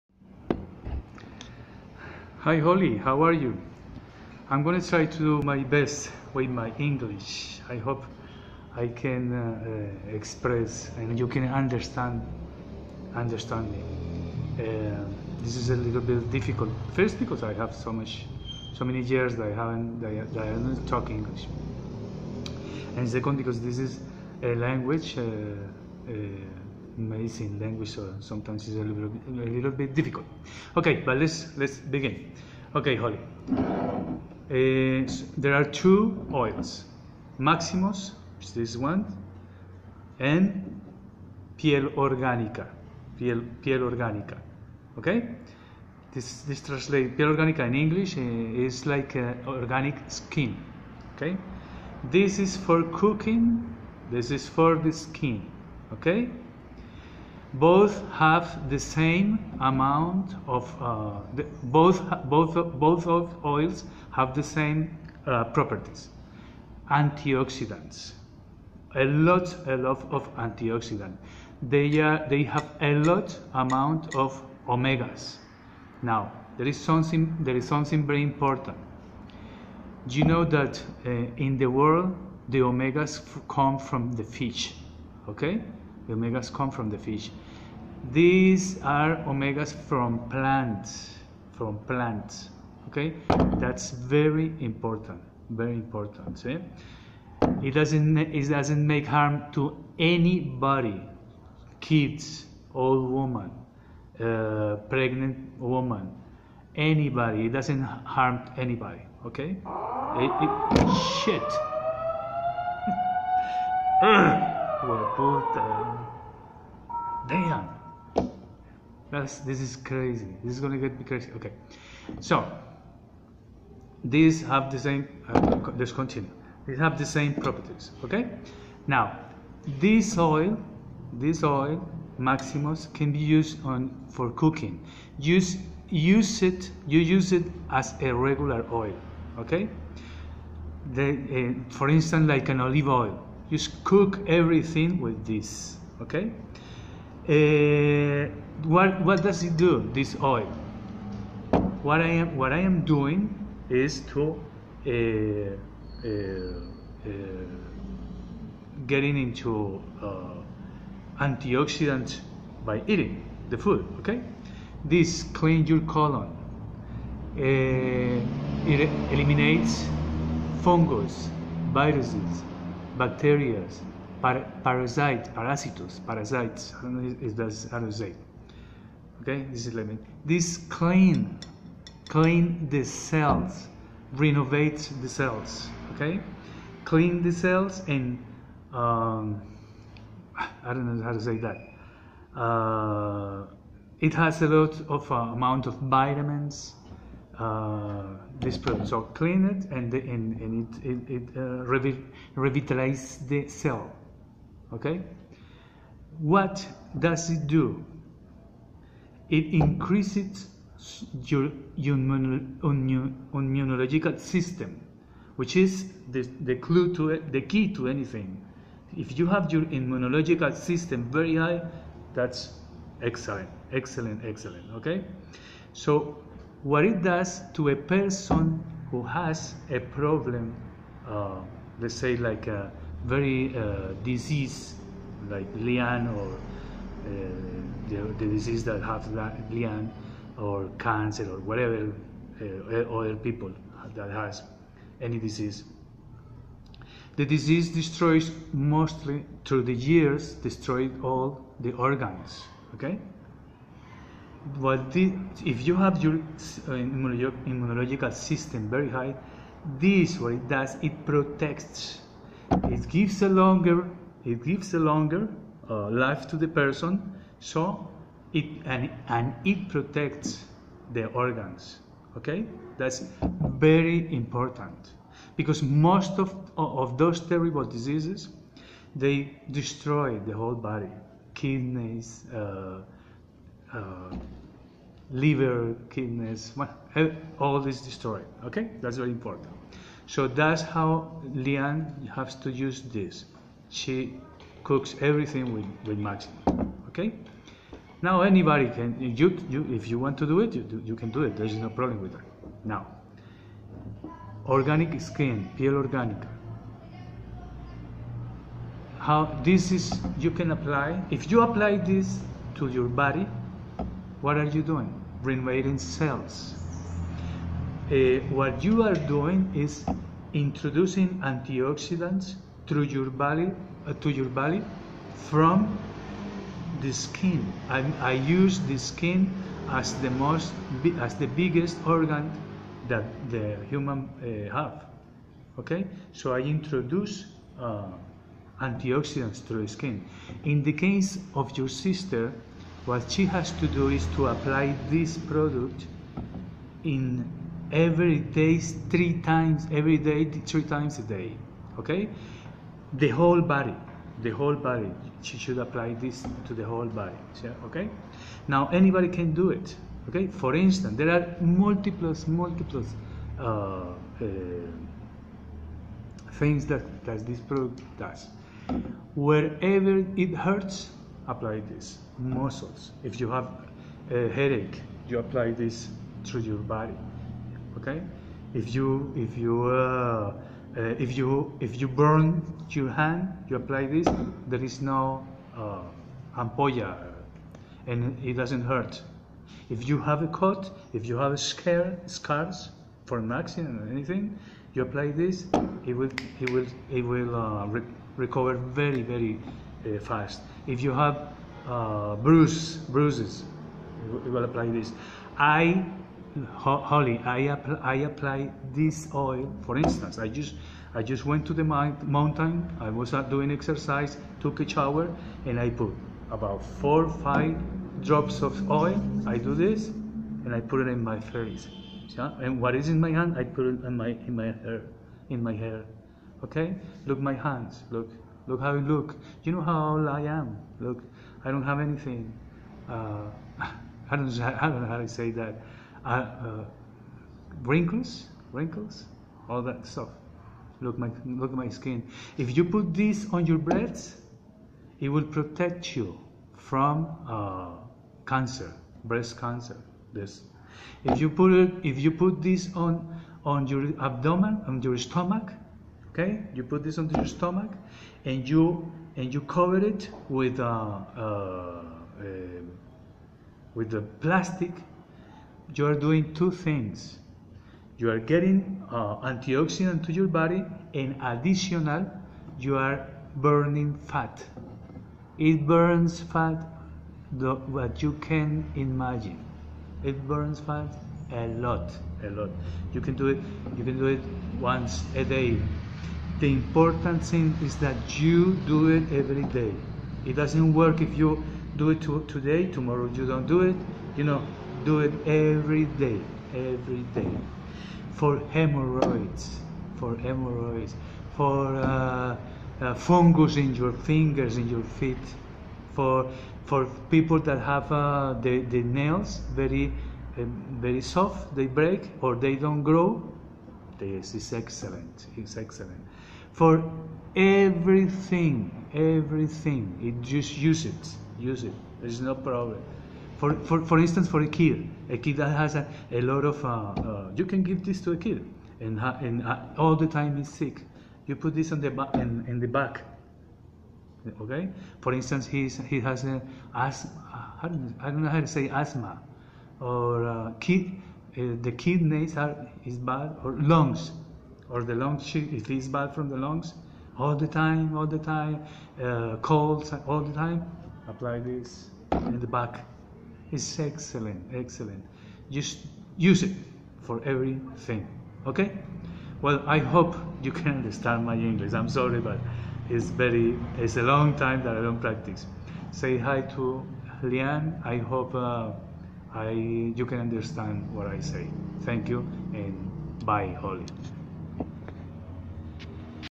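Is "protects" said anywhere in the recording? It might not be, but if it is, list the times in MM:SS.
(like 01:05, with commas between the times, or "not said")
04:21, 04:29, 07:25.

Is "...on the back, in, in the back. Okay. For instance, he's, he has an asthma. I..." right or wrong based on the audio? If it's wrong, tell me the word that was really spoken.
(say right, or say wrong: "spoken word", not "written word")
right.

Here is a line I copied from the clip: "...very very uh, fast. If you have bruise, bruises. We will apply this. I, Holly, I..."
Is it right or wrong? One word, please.
right.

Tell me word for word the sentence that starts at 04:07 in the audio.
The disease destroys mostly through the years, destroyed all the organs.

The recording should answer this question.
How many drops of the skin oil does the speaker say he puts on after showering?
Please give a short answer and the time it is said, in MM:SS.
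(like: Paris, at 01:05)
4 or 5 drops, at 06:56.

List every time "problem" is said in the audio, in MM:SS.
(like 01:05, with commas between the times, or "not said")
03:49, 05:01, 08:42.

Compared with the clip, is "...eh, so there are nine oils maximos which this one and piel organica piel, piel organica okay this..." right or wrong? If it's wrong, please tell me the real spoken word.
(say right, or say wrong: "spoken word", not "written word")
wrong: "two", not "nine".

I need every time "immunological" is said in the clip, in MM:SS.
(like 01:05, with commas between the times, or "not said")
03:31, 03:39, 04:17.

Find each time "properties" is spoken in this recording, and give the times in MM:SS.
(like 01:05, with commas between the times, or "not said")
01:05, 02:07.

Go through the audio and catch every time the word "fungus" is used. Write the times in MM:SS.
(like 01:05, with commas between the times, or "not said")
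02:50, 08:22.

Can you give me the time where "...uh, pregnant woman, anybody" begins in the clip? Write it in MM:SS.
01:44.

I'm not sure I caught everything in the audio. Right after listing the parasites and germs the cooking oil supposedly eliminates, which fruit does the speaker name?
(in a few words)
lemon.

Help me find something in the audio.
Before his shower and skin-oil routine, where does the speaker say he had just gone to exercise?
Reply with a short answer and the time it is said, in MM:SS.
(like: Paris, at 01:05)
the mountain, at 06:51.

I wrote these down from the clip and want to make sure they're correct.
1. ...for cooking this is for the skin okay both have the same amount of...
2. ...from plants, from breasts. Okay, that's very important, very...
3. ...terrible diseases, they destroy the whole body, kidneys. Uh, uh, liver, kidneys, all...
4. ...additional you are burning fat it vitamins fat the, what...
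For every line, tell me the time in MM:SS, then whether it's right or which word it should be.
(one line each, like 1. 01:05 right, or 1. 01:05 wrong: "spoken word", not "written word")
1. 00:52 right
2. 01:29 wrong: "plants", not "breasts"
3. 04:37 right
4. 07:51 wrong: "burns", not "vitamins".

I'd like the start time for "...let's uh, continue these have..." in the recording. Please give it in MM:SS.
02:05.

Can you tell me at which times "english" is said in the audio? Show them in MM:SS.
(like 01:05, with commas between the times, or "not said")
00:06, 00:21, 00:47, 09:21.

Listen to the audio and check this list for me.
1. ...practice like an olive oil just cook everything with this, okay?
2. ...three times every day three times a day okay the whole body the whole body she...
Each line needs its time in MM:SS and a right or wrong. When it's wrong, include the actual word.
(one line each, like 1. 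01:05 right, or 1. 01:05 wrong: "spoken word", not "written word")
1. 02:21 wrong: "instance", not "practice"
2. 05:48 right.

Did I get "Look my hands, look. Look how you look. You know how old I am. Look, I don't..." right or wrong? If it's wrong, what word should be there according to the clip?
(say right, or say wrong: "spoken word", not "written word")
right.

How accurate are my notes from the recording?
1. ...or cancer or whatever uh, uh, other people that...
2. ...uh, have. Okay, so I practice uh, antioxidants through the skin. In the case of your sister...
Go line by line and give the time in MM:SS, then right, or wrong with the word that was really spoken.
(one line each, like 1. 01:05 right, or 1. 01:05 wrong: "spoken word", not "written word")
1. 04:00 right
2. 05:34 wrong: "introduce", not "practice".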